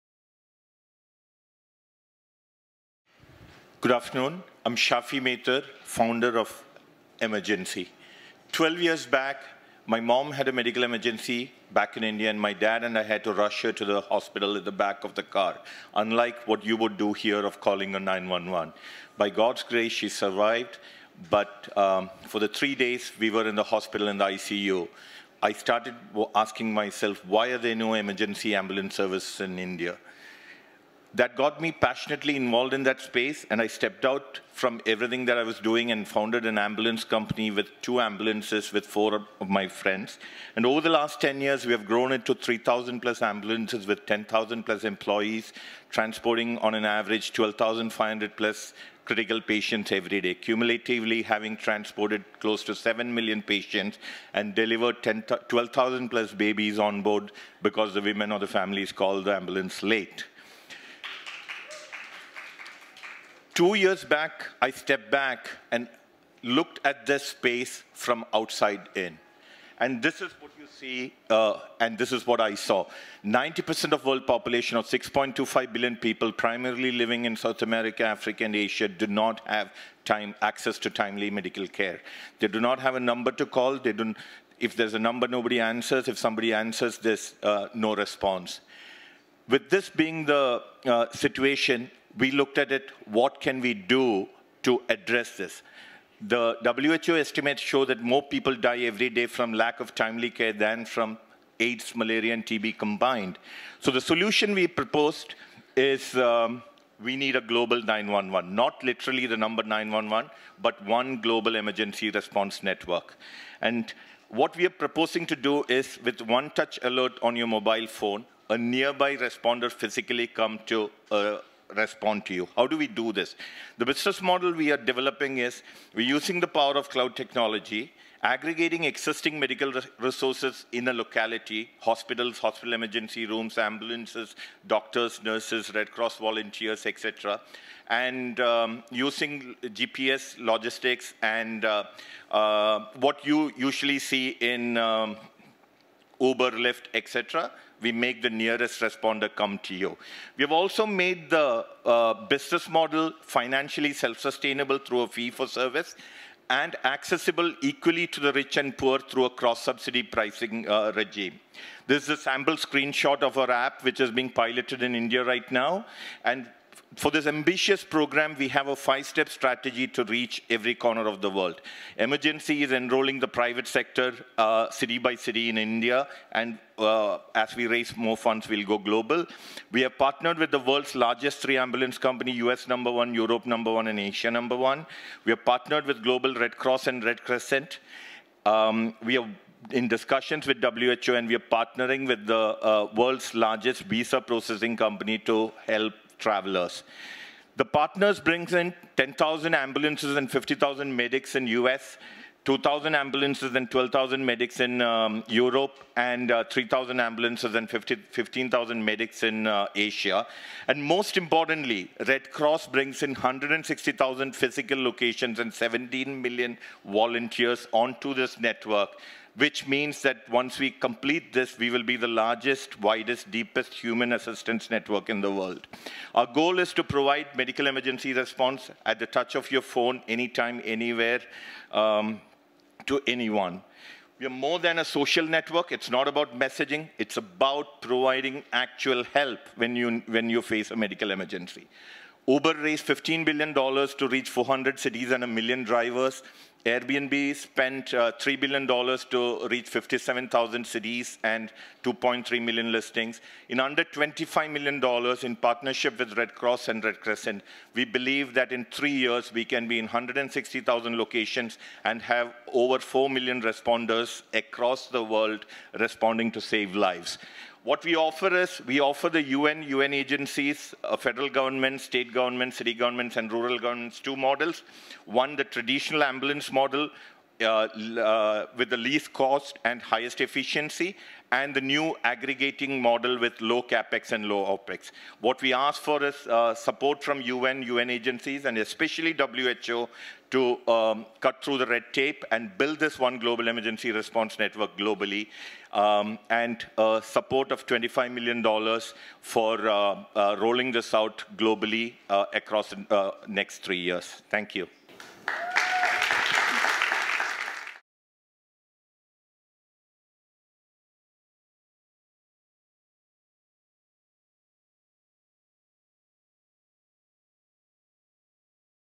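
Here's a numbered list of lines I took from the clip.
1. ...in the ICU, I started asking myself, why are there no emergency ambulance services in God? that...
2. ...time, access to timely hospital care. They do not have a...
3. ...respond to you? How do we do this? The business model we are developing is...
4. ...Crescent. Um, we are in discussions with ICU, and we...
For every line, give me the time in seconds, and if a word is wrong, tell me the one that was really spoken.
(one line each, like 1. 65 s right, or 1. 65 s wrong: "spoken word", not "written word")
1. 24 s wrong: "India", not "God"
2. 80 s wrong: "medical", not "hospital"
3. 121 s right
4. 187 s wrong: "WHO", not "ICU".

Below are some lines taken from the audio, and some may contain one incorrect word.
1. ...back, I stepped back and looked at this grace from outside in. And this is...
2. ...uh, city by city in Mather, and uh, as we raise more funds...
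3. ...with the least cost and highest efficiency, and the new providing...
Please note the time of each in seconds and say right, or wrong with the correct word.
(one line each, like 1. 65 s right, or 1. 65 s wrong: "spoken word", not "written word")
1. 64 s wrong: "space", not "grace"
2. 174 s wrong: "India", not "Mather"
3. 278 s wrong: "aggregating", not "providing".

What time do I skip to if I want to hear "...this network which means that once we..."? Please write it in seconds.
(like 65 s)
218 s.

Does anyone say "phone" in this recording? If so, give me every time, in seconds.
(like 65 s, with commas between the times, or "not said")
117 s, 229 s.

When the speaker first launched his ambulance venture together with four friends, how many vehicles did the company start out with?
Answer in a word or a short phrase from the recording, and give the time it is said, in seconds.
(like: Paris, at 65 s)
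2, at 37 s.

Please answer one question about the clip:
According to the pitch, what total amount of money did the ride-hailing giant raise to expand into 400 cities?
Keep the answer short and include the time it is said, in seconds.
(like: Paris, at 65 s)
$15 billion, at 242 s.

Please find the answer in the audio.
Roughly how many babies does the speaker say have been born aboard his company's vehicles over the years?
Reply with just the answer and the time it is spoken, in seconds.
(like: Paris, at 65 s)
12,000 plus, at 55 s.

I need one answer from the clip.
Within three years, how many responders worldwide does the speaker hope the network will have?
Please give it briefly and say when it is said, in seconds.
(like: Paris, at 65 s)
over 4 million, at 262 s.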